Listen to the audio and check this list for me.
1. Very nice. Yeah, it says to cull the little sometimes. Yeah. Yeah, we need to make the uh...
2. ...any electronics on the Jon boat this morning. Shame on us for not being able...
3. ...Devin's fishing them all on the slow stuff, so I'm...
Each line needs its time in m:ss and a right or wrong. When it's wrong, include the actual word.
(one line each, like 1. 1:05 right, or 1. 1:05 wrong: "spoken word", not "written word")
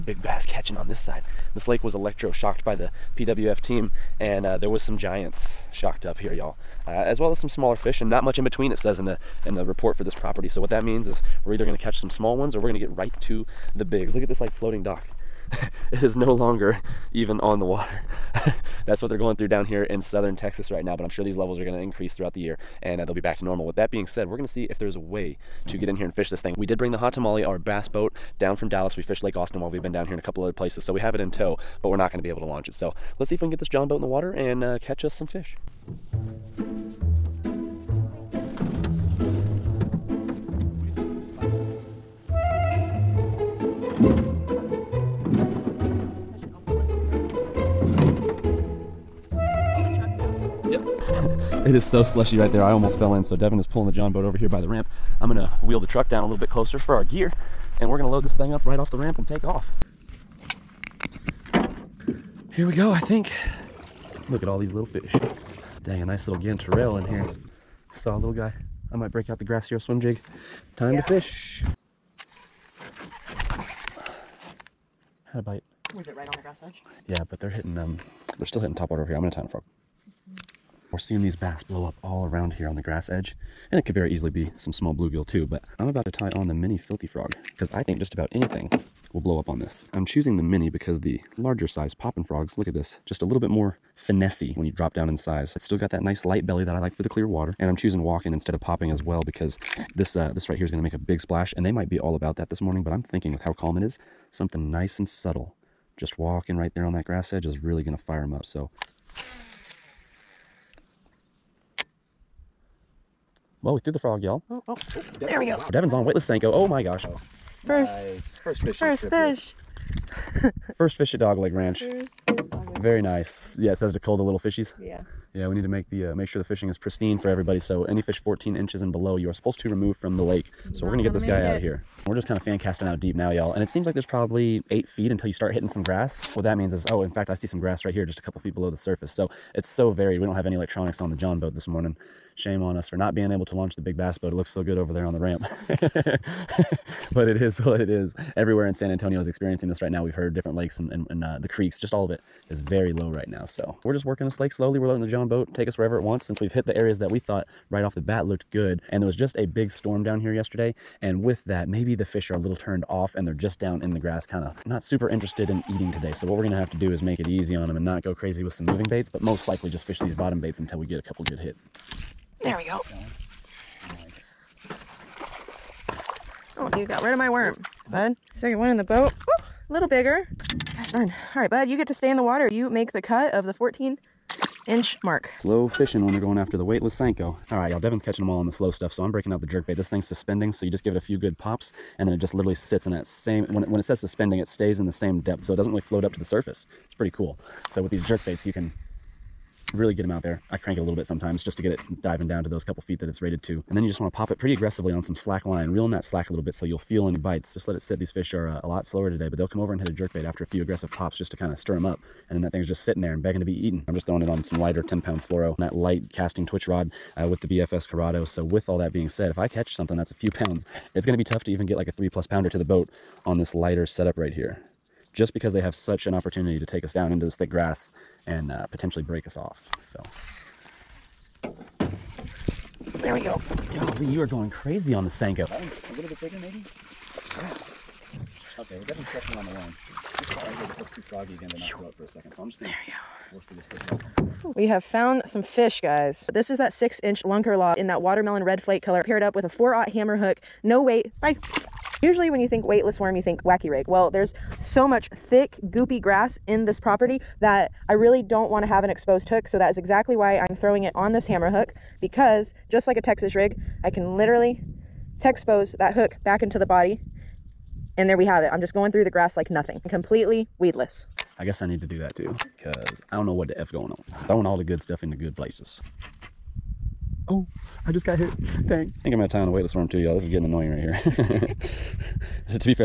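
1. 2:02 wrong: "fishies", not "sometimes"
2. 2:20 right
3. 3:07 wrong: "catching", not "fishing".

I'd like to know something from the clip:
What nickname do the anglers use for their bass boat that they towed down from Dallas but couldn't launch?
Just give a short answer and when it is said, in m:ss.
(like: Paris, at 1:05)
hot tamale, at 0:26.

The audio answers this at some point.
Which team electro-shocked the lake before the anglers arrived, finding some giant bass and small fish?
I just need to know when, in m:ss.
0:03.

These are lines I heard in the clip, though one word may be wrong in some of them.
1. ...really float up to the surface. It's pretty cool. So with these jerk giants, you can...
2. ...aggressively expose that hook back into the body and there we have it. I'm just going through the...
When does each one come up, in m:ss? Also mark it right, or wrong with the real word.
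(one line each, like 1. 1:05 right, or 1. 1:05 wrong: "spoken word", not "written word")
1. 3:15 wrong: "baits", not "giants"
2. 4:24 wrong: "literally", not "aggressively".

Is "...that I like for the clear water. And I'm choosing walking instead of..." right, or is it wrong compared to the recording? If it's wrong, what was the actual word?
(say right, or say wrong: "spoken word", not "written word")
right.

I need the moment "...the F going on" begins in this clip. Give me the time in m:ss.
4:33.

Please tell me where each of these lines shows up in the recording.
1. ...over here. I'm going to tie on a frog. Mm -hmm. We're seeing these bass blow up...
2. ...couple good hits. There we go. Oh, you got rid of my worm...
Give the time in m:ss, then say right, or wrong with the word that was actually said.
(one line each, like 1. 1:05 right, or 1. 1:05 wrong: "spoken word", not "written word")
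1. 1:19 right
2. 2:51 right.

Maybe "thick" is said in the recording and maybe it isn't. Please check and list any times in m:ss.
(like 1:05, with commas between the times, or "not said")
3:47, 4:03, 4:15.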